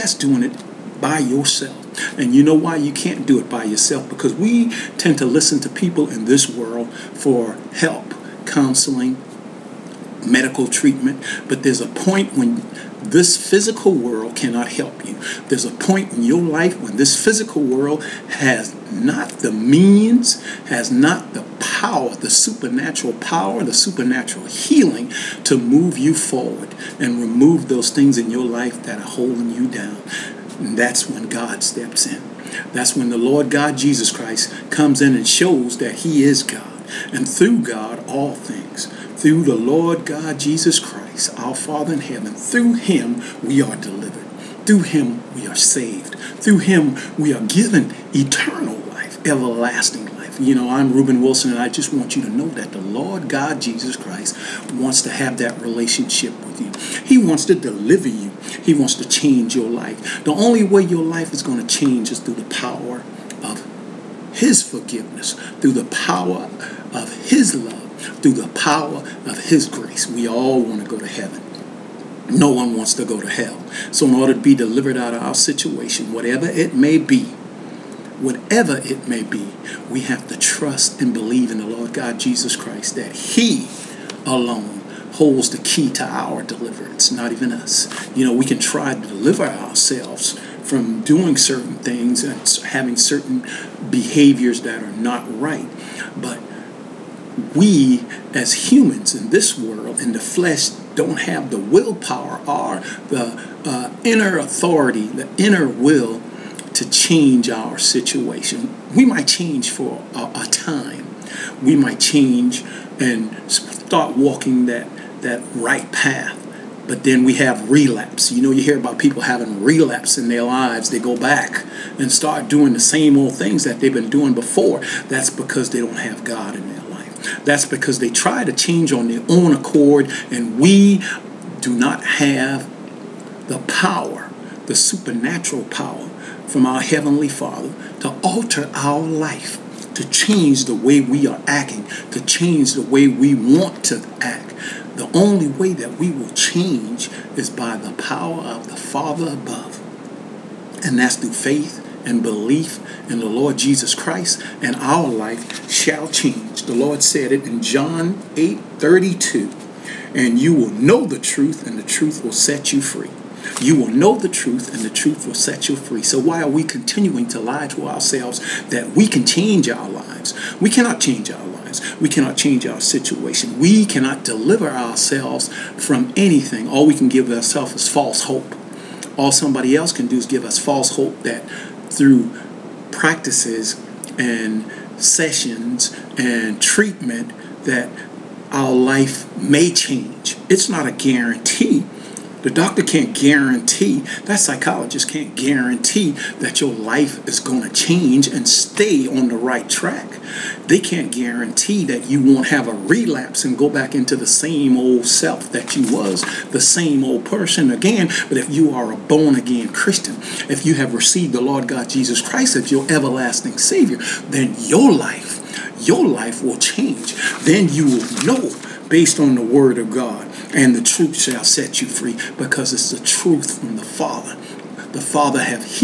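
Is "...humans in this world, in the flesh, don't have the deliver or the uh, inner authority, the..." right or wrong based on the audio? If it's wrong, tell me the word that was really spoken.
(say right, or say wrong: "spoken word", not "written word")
wrong: "willpower", not "deliver".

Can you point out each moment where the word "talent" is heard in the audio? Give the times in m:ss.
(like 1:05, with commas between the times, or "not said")
not said.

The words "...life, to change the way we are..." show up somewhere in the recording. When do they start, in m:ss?
2:18.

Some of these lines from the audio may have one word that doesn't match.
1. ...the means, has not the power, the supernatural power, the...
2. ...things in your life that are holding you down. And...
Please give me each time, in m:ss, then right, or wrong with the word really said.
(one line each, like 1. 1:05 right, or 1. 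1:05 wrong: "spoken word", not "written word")
1. 0:19 right
2. 0:27 right.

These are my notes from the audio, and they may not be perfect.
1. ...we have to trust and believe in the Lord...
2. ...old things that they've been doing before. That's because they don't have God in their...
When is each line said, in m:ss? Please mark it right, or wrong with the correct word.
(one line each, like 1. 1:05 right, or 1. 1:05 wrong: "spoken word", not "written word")
1. 1:19 right
2. 2:03 right.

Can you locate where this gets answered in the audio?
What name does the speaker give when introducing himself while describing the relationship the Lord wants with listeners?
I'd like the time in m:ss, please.
0:50.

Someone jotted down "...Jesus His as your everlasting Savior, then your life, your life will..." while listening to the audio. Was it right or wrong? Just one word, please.
wrong.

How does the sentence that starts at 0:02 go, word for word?
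And you know why you can't do it by yourself?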